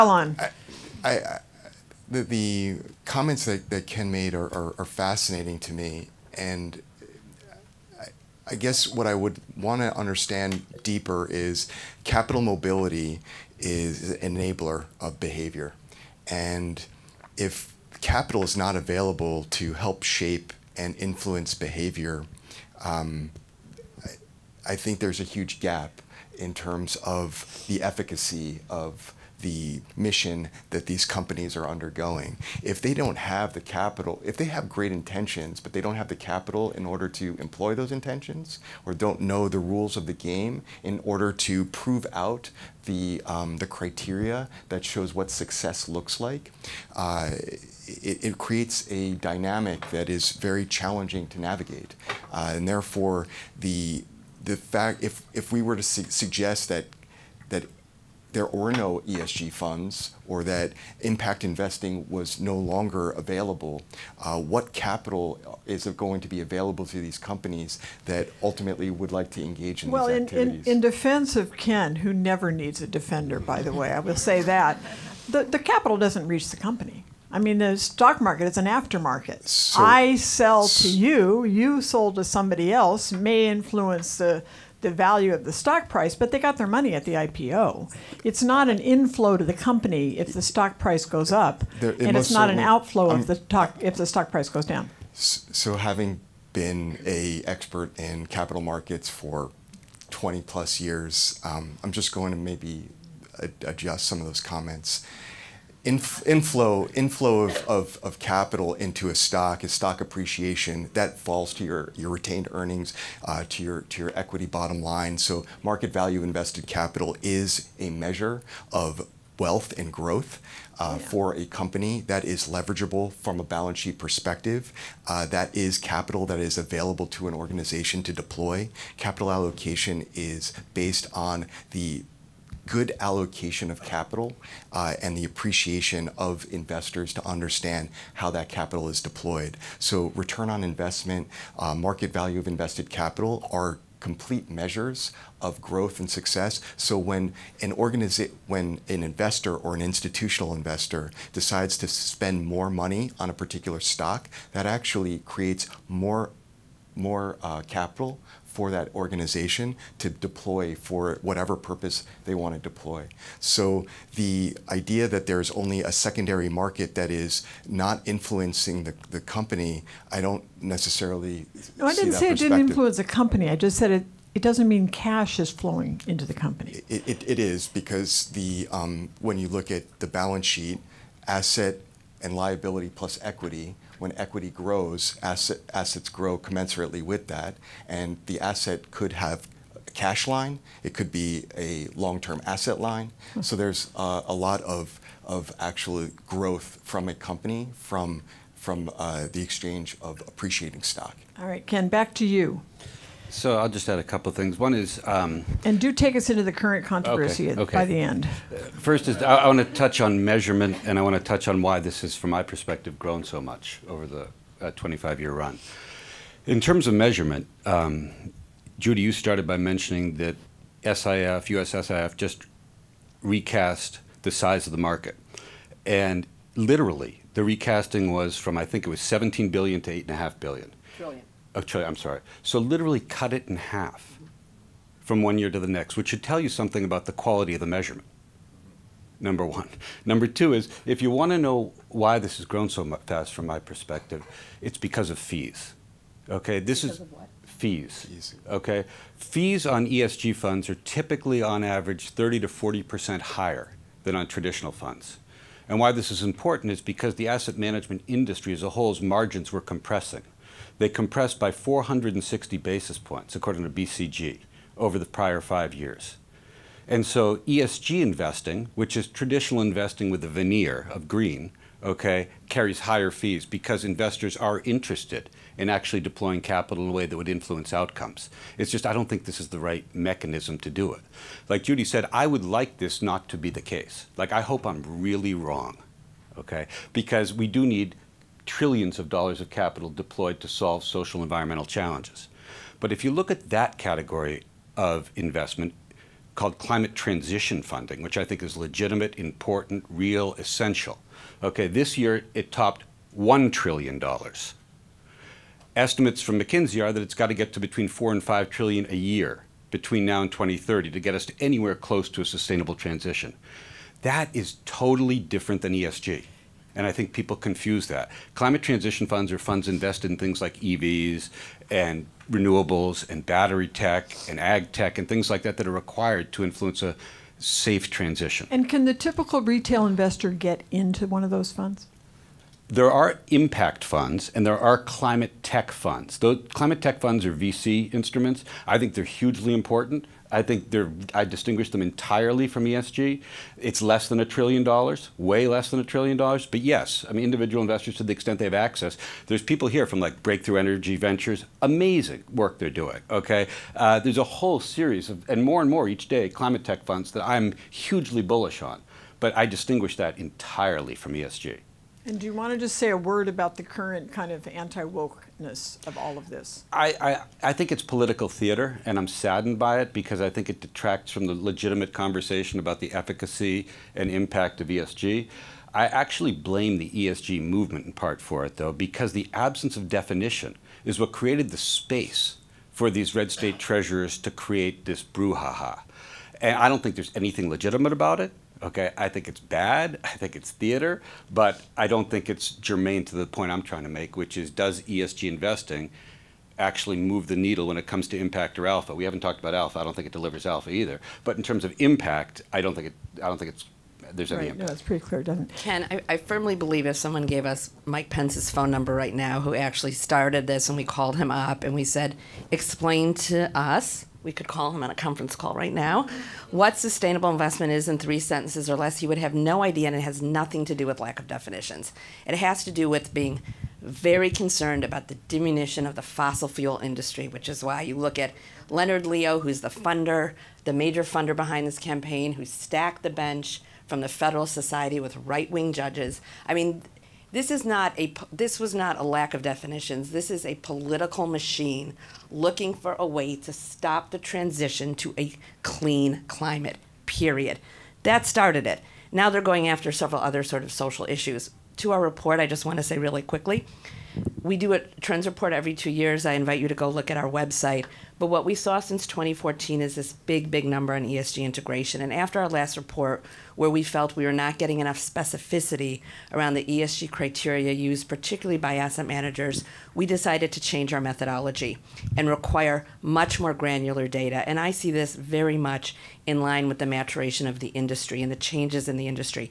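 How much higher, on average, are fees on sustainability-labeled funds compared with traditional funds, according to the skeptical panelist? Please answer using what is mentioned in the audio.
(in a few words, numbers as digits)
30 to 40%.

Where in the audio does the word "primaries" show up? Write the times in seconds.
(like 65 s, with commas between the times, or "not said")
not said.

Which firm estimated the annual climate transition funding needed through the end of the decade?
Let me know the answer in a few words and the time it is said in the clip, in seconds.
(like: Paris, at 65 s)
McKinsey, at 306 s.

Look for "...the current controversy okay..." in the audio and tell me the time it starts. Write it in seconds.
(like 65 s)
206 s.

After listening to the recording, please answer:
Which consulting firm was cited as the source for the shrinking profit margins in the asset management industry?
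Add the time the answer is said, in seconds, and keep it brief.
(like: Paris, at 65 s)
BCG, at 263 s.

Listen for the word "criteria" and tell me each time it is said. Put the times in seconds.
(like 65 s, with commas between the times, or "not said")
43 s, 467 s.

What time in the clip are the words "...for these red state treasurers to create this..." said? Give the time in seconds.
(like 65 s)
382 s.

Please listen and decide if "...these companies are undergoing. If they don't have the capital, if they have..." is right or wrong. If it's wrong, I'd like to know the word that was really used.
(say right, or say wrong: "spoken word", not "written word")
right.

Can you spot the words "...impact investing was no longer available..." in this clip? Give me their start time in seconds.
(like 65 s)
61 s.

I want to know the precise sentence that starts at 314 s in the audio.
That is totally different than ESG.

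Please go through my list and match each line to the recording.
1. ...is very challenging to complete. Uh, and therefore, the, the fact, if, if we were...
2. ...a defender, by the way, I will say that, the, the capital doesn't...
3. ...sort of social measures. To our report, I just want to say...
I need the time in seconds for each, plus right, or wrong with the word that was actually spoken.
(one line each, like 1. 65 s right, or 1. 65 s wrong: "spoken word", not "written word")
1. 50 s wrong: "navigate", not "complete"
2. 72 s right
3. 450 s wrong: "issues", not "measures".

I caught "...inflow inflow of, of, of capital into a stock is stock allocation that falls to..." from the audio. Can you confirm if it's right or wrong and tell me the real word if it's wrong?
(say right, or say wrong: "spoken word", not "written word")
wrong: "appreciation", not "allocation".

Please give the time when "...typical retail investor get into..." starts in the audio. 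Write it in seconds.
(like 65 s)
328 s.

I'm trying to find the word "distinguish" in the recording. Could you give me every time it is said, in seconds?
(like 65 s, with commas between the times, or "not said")
341 s, 359 s.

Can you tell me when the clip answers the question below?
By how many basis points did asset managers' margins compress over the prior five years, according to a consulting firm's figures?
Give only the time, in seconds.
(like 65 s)
261 s.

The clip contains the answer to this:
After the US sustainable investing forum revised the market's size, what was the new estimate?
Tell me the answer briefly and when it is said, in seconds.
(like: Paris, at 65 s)
8.5 trillion, at 230 s.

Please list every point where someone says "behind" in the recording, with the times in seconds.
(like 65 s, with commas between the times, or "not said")
431 s.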